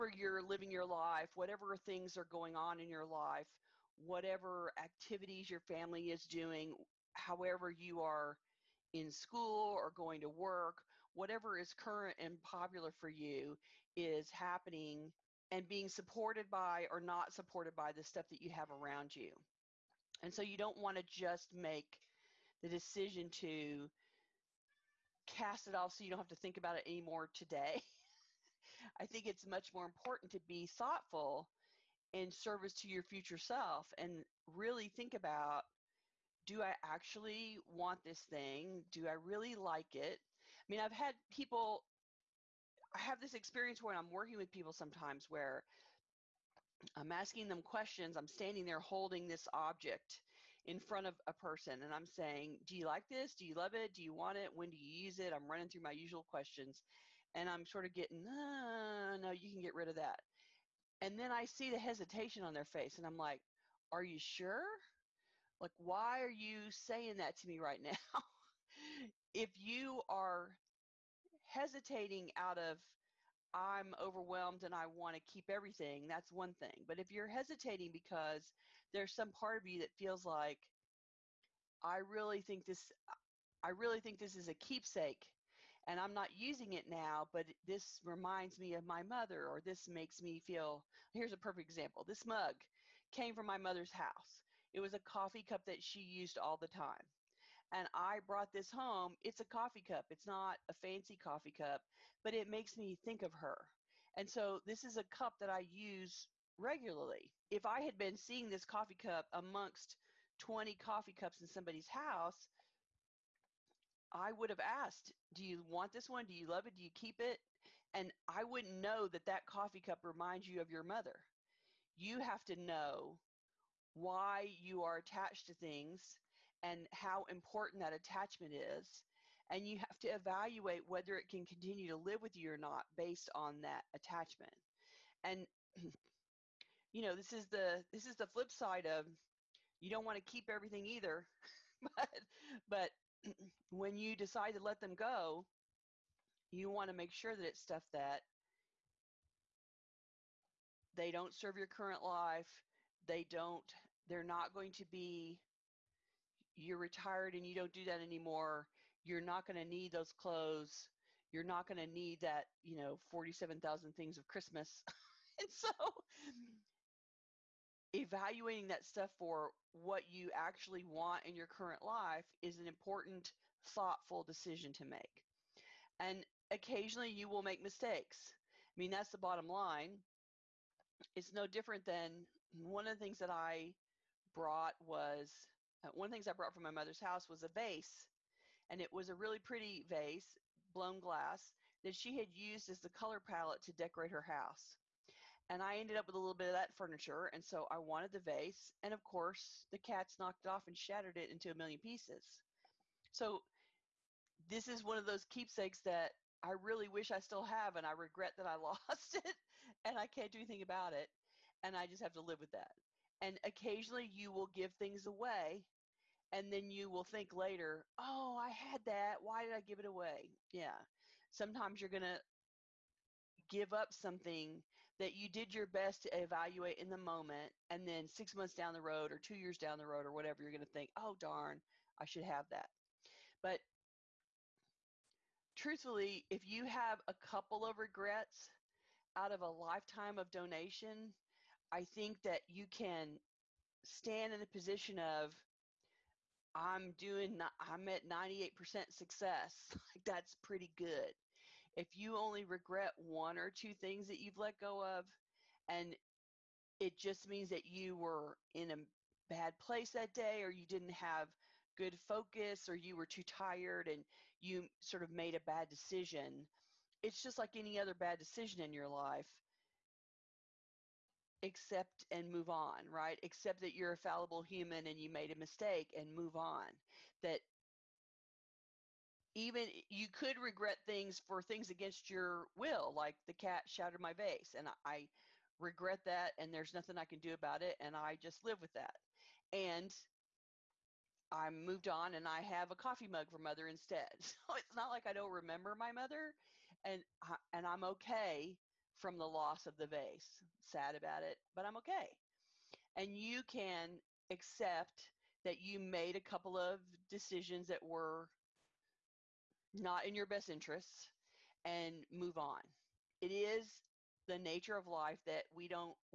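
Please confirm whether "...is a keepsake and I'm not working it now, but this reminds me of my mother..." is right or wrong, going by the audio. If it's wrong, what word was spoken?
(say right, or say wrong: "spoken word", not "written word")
wrong: "using", not "working".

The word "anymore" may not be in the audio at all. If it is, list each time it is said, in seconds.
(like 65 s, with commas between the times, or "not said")
26 s, 157 s.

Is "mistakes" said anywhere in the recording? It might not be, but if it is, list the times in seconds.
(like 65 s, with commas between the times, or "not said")
177 s, 275 s.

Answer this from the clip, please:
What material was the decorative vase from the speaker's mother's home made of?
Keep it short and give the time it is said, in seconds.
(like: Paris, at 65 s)
blown glass, at 190 s.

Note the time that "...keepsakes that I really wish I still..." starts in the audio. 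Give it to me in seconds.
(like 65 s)
205 s.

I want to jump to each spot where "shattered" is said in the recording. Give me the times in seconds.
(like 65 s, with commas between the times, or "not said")
200 s, 283 s.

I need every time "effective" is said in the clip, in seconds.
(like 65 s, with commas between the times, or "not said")
not said.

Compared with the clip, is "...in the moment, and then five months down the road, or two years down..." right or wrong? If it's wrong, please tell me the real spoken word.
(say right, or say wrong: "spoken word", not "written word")
wrong: "six", not "five".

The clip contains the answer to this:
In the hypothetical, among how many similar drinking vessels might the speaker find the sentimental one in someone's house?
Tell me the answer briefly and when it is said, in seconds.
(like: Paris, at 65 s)
20, at 110 s.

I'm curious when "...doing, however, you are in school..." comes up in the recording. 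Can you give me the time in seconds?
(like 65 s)
6 s.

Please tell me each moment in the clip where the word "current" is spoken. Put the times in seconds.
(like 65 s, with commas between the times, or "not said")
11 s, 151 s, 171 s.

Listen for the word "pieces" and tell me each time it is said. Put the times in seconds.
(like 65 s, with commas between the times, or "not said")
201 s.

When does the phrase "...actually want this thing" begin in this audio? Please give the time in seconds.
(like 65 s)
36 s.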